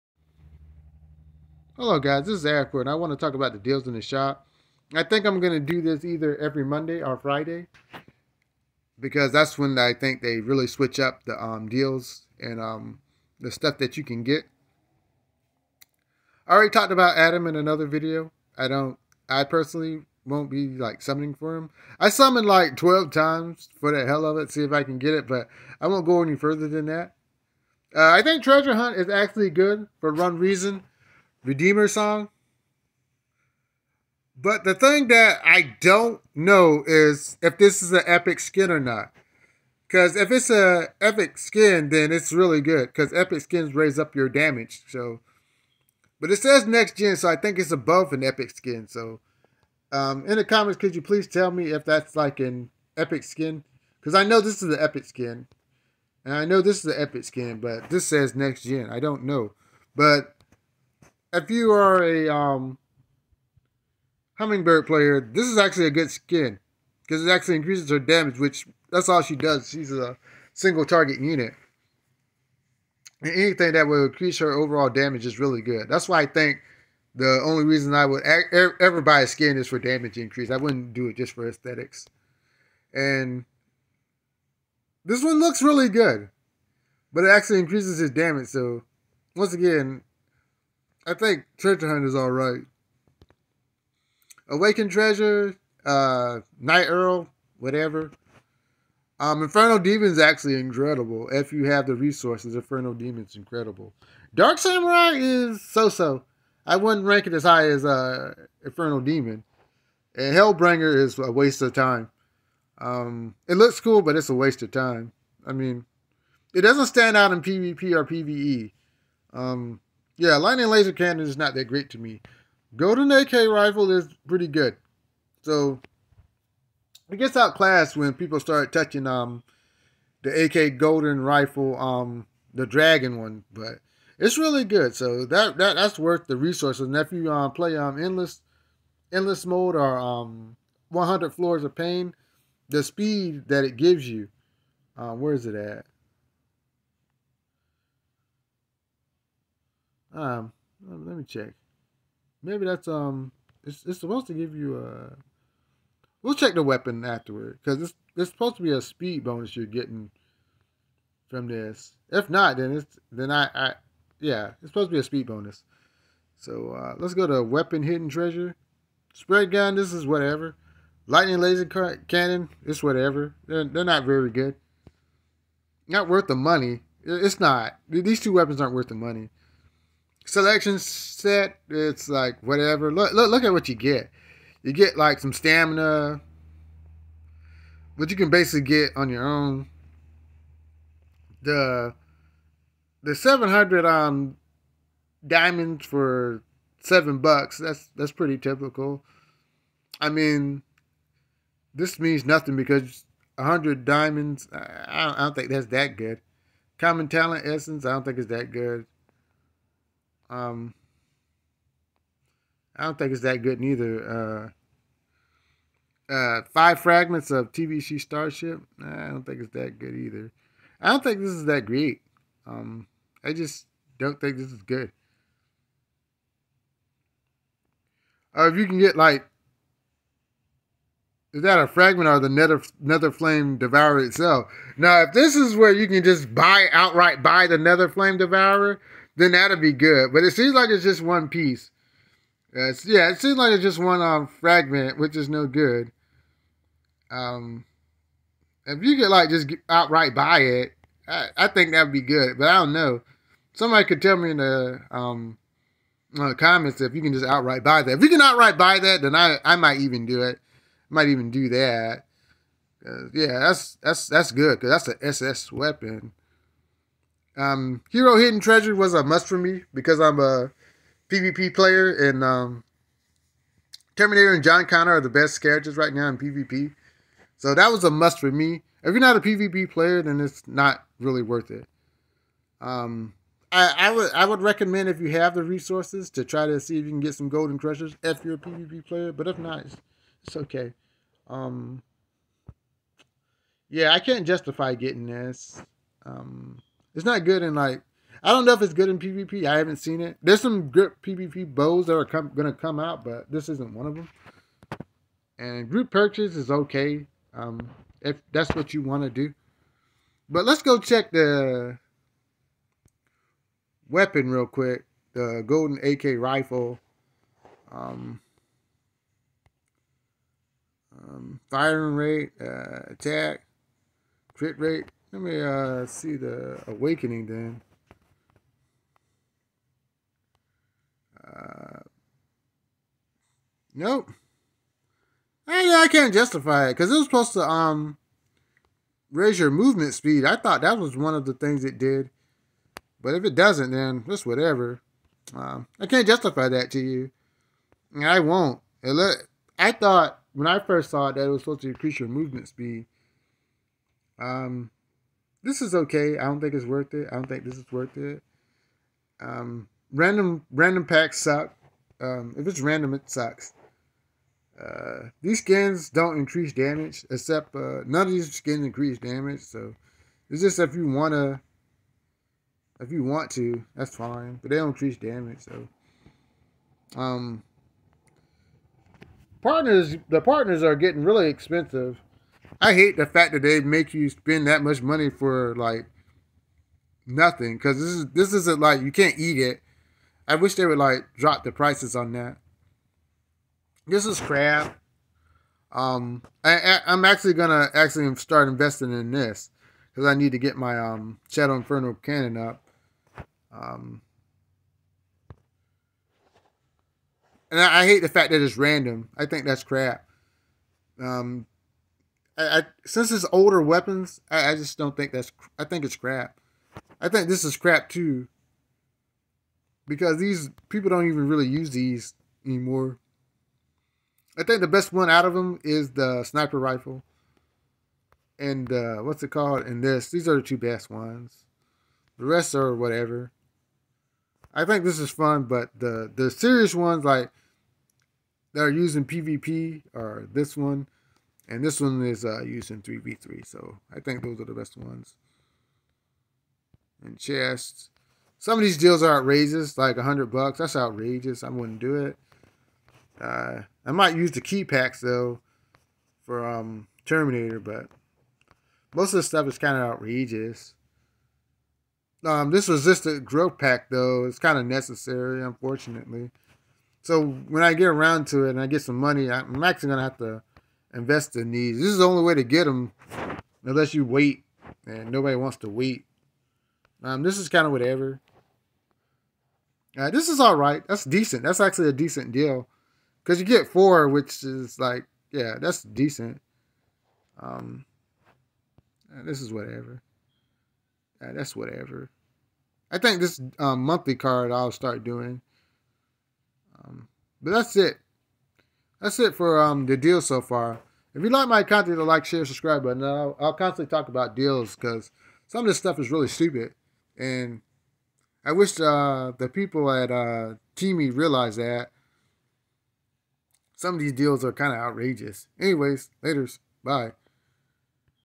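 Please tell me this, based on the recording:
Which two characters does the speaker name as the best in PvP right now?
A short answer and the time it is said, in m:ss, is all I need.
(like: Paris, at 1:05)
Terminator and John Connor, at 4:33.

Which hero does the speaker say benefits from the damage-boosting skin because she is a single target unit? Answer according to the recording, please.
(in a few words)
Hummingbird.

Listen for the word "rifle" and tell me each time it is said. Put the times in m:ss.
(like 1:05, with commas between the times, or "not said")
2:03, 2:11, 5:16, 7:06.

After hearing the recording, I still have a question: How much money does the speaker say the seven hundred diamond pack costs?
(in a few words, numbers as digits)
7 bucks.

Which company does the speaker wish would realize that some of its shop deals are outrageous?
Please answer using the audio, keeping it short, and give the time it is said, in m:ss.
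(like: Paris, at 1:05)
TiMi, at 8:30.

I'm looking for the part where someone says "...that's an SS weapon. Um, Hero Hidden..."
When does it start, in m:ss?
4:24.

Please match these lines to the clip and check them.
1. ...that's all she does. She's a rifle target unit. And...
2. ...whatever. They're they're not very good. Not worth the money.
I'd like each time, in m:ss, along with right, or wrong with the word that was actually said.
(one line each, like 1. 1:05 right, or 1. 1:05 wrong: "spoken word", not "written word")
1. 1:08 wrong: "single", not "rifle"
2. 2:52 right.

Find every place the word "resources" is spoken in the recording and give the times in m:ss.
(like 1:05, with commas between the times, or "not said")
1:41, 2:16, 4:45.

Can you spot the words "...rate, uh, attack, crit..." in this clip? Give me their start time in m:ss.
5:21.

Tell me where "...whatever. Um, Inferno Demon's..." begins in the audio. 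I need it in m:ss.
1:37.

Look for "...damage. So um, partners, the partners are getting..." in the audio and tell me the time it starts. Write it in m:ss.
6:14.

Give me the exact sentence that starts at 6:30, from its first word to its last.
I wish they would like drop the prices on that.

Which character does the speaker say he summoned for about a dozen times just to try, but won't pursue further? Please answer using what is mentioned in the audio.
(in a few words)
Adam.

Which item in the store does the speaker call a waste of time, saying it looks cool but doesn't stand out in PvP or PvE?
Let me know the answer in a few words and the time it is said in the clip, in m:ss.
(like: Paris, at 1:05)
Hellbringer, at 1:50.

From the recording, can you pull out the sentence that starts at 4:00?
But it seems like it's just one piece.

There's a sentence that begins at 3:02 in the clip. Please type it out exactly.
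Look, look, look at what you get.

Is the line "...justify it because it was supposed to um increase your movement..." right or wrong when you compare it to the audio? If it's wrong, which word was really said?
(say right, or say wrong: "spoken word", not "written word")
wrong: "raise", not "increase".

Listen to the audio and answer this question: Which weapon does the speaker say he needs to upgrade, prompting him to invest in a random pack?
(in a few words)
Shadow Inferno cannon.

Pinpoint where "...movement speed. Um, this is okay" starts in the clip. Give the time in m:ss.
5:52.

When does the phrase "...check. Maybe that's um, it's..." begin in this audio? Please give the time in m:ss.
2:31.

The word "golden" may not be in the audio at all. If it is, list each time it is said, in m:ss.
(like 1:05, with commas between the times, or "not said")
2:02, 2:10, 4:47, 5:15.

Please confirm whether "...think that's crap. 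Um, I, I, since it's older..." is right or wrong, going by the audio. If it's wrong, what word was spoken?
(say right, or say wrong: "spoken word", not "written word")
right.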